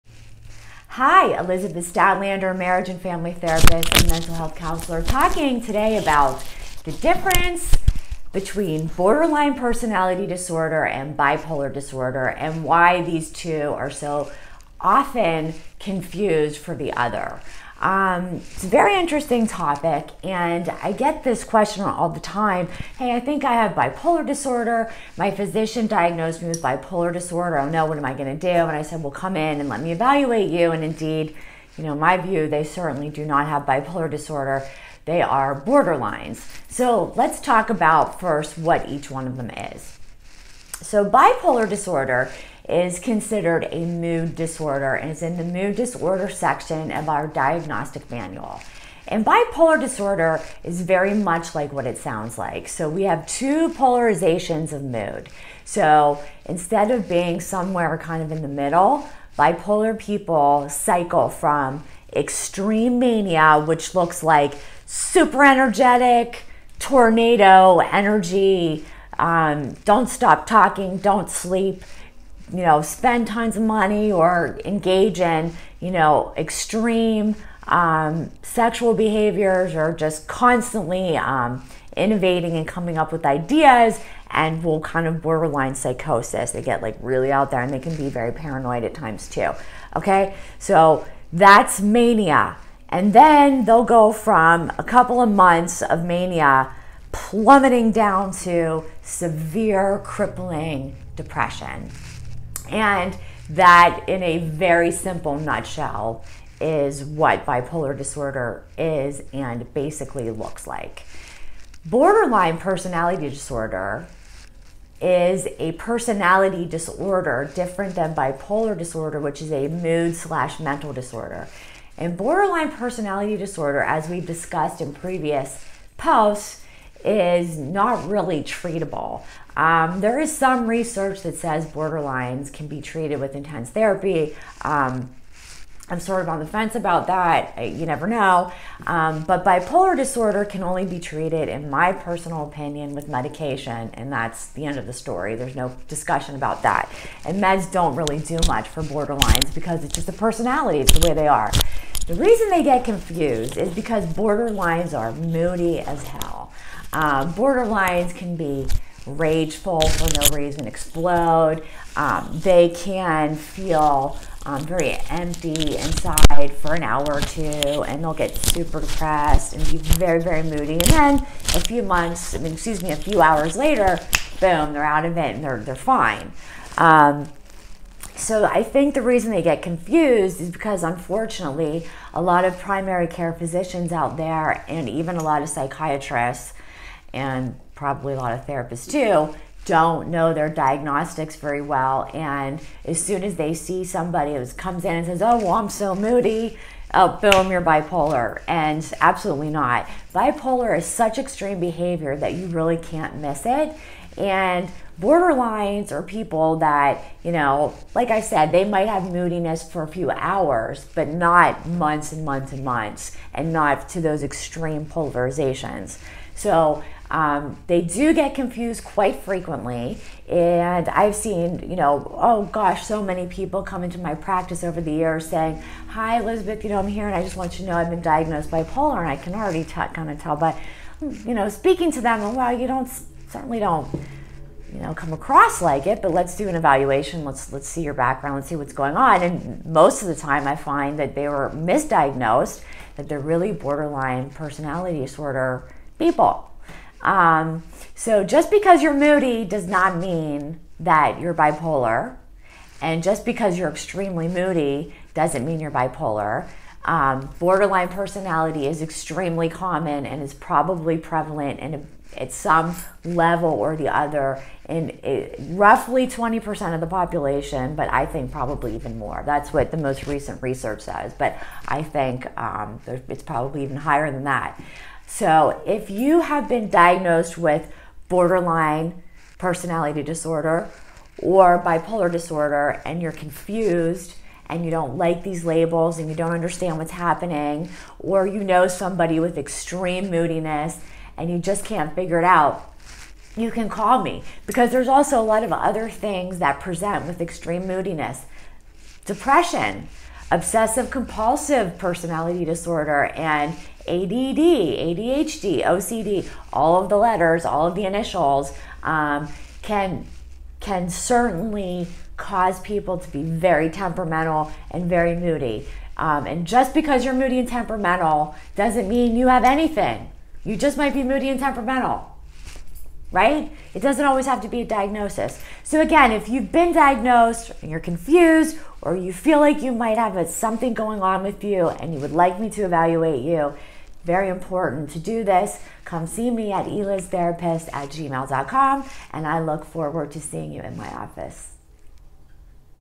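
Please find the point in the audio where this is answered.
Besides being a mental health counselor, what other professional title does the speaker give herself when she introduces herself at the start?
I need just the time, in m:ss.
0:02.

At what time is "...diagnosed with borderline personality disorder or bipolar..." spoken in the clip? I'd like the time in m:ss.
4:36.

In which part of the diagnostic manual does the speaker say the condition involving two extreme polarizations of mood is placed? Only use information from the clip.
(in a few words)
Mood disorder section.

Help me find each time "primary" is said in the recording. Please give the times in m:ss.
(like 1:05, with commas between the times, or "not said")
3:02.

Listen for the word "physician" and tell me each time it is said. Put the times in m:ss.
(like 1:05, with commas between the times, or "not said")
0:25, 3:03.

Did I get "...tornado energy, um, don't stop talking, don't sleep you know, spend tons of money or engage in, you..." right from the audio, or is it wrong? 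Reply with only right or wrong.
right.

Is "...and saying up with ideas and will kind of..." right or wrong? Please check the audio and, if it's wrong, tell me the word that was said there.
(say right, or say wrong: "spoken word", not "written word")
wrong: "coming", not "saying".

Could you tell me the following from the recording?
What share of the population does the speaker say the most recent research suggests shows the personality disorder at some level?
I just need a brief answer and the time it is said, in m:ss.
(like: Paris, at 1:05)
20%, at 4:26.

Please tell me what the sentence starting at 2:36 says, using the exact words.
Uh, borderlines can be rageful for no reason, explode.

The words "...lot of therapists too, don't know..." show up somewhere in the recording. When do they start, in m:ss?
3:08.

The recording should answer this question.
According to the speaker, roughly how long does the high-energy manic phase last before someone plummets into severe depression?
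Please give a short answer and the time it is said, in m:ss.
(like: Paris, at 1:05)
A couple of months, at 1:34.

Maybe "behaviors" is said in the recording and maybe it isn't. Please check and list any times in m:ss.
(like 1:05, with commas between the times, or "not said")
1:18, 3:21.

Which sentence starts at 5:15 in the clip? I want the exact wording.
Um, and just because you're moody and temperamental doesn't mean you have anything.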